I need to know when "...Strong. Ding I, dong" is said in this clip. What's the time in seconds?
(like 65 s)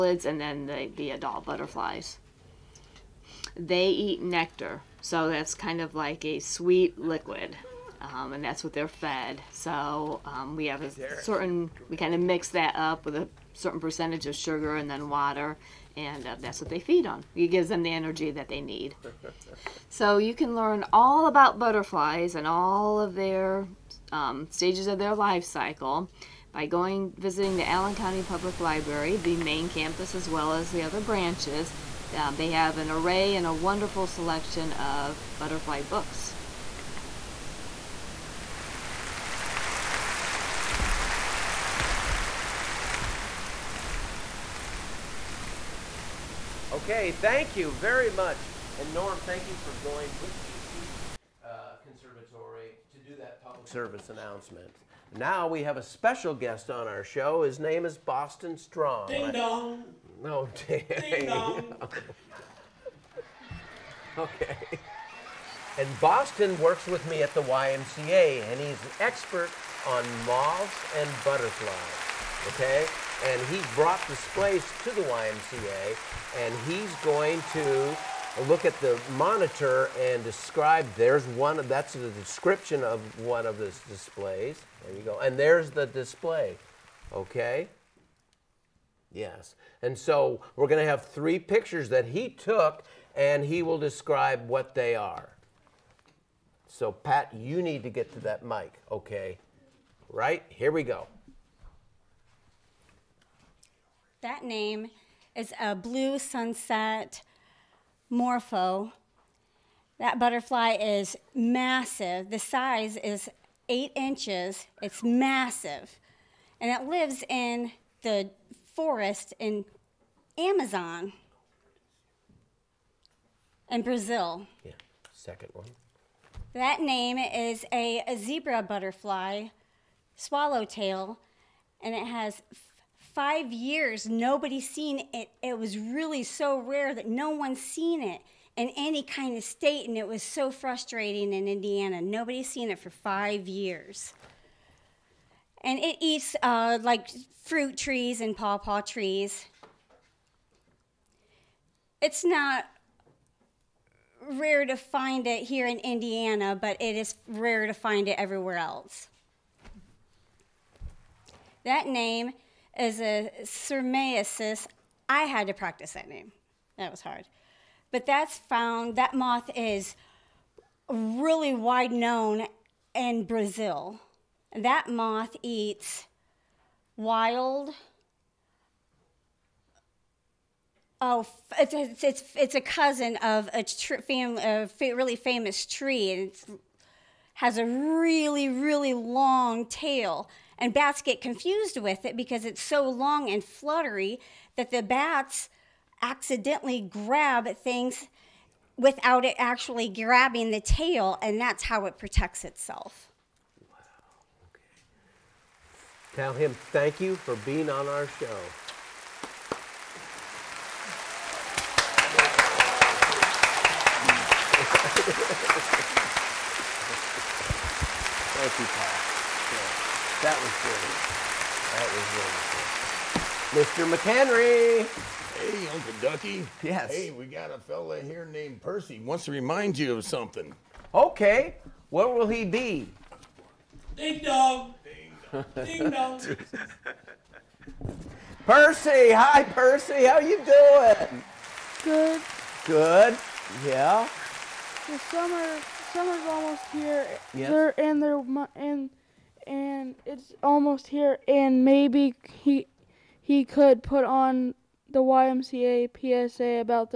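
58 s.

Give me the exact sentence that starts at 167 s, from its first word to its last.
But that's found, that moth is really wide known in Brazil.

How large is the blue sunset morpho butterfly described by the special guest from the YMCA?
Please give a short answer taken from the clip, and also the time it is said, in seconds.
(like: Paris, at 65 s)
8 inches, at 113 s.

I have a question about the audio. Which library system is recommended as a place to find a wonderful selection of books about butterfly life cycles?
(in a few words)
Allen County Public Library.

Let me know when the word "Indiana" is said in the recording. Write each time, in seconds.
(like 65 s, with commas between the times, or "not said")
141 s, 155 s.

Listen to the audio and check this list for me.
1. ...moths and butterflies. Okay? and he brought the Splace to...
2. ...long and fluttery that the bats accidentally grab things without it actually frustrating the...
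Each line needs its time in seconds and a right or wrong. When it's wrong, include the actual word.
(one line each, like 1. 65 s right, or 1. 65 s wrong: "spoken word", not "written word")
1. 70 s right
2. 192 s wrong: "grabbing", not "frustrating".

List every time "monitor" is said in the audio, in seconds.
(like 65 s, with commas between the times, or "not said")
79 s.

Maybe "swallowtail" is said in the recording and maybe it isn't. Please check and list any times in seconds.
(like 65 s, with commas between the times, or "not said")
130 s.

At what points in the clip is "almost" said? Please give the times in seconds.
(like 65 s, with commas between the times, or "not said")
246 s, 250 s.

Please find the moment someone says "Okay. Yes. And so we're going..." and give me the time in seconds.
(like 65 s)
87 s.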